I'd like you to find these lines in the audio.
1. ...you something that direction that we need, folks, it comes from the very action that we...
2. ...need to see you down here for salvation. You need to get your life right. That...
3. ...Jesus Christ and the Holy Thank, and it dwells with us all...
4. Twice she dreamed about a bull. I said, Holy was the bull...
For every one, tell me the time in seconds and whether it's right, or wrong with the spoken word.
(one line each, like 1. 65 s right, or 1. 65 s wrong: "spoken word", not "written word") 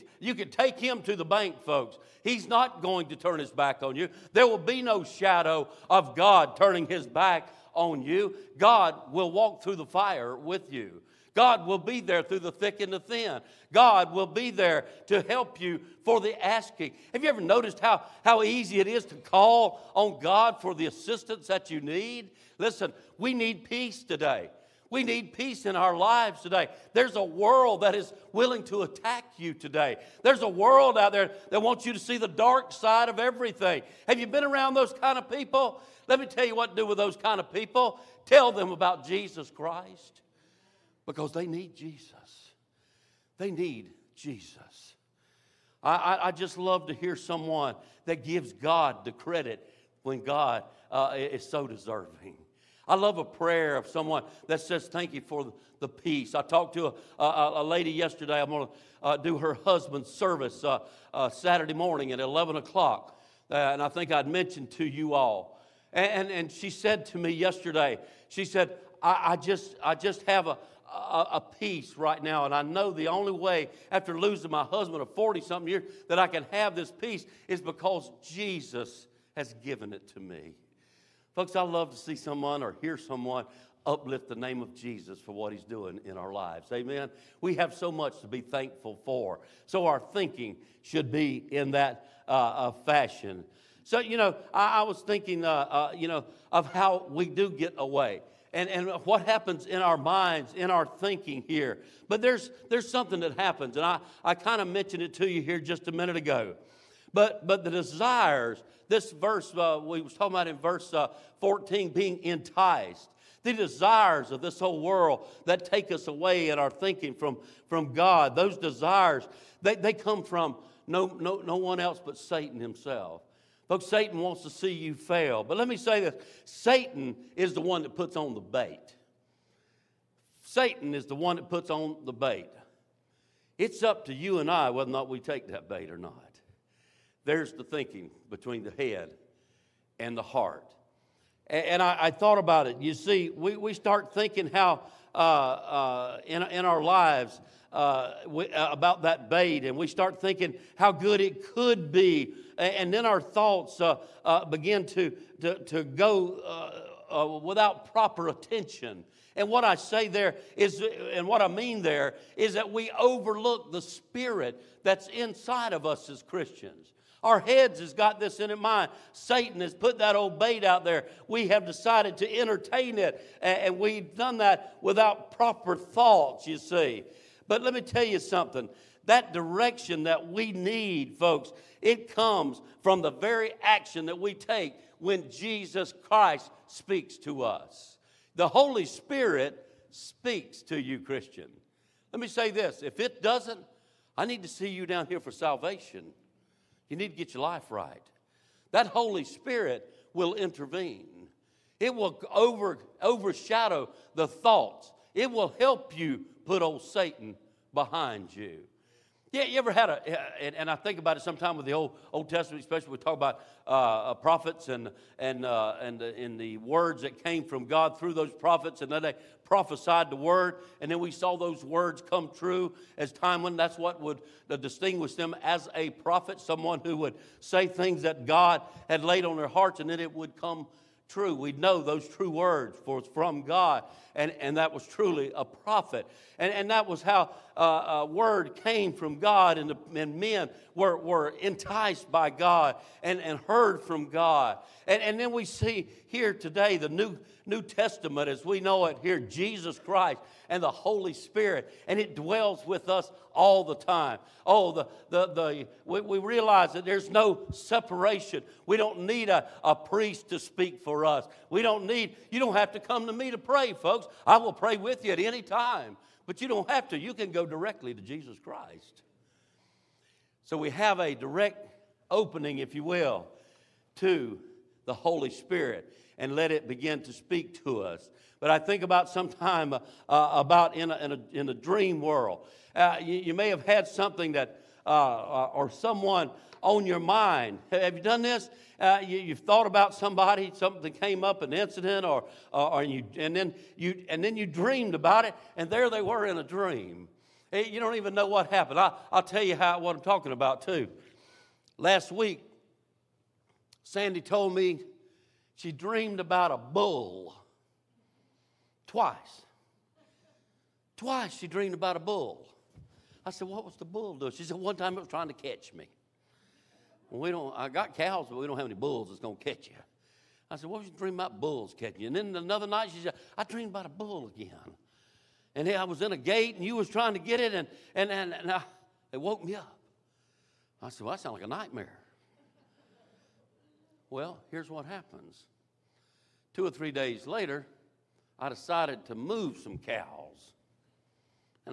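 1. 178 s right
2. 194 s right
3. 249 s wrong: "Spirit", not "Thank"
4. 310 s wrong: "What", not "Holy".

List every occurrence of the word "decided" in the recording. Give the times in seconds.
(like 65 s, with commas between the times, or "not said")
171 s, 338 s.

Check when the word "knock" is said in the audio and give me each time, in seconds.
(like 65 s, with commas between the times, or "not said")
not said.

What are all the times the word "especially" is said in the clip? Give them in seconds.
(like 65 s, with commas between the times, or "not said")
212 s.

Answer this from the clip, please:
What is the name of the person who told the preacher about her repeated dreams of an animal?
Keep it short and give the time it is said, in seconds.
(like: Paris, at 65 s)
Sandy, at 303 s.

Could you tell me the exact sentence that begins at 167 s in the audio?
Our heads has got this in mind.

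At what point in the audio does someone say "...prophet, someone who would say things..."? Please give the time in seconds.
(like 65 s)
225 s.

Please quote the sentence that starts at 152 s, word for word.
And then our thoughts uh, uh, begin to, to, to go without proper attention.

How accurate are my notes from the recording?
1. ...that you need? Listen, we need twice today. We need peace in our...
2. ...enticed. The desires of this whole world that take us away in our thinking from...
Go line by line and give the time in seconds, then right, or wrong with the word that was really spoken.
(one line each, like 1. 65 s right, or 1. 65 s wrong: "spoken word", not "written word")
1. 21 s wrong: "peace", not "twice"
2. 112 s right.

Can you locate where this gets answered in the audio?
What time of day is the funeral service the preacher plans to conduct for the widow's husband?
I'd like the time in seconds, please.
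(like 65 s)
62 s.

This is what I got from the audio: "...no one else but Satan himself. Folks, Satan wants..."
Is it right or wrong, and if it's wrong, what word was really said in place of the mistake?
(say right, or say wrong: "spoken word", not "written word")
right.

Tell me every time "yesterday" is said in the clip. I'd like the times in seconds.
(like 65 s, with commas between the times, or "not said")
57 s, 67 s.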